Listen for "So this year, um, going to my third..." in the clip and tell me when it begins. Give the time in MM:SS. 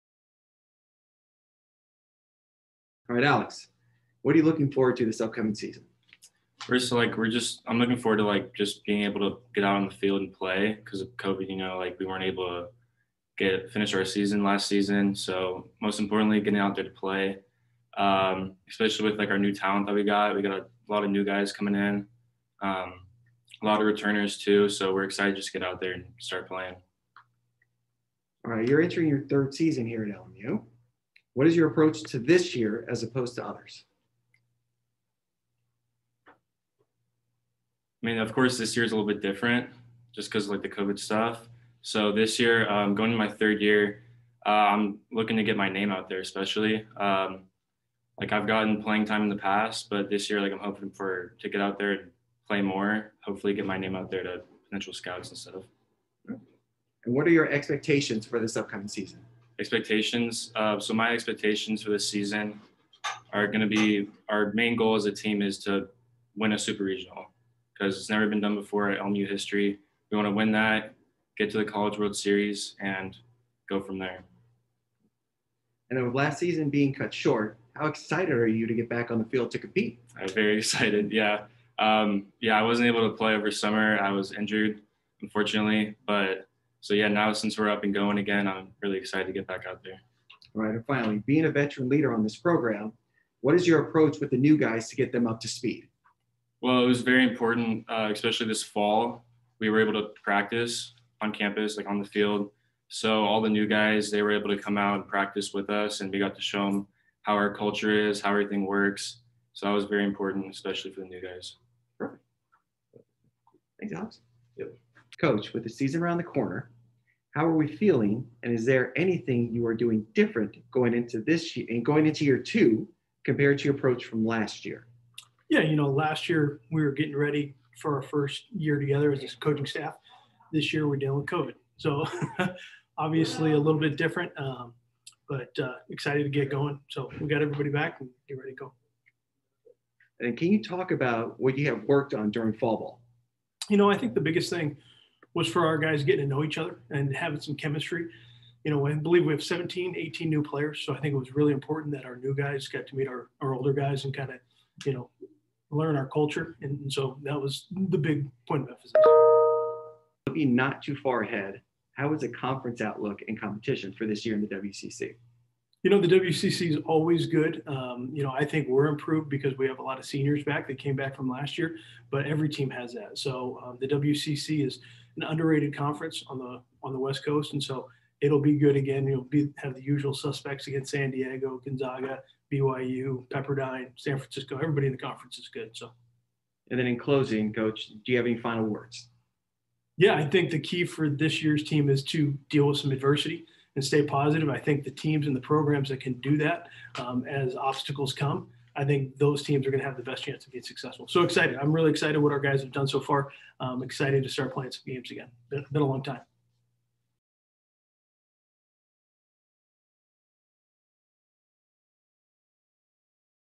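00:41.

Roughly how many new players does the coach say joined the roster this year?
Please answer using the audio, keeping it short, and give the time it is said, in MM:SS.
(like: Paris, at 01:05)
17 or 18, at 02:29.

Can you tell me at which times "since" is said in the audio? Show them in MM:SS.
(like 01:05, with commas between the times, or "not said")
01:27.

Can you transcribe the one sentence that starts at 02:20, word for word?
And can you talk about what you have worked on during fall ball?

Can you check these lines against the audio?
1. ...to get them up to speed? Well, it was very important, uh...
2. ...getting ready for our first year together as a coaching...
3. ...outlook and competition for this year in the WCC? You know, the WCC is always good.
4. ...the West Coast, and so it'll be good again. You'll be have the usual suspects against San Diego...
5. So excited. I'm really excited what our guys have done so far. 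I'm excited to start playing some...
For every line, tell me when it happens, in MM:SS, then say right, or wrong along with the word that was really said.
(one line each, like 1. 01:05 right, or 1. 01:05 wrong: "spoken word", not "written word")
1. 01:34 right
2. 02:06 right
3. 02:42 right
4. 02:56 right
5. 03:21 right.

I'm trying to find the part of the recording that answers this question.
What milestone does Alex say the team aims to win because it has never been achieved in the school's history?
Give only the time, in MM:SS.
01:06.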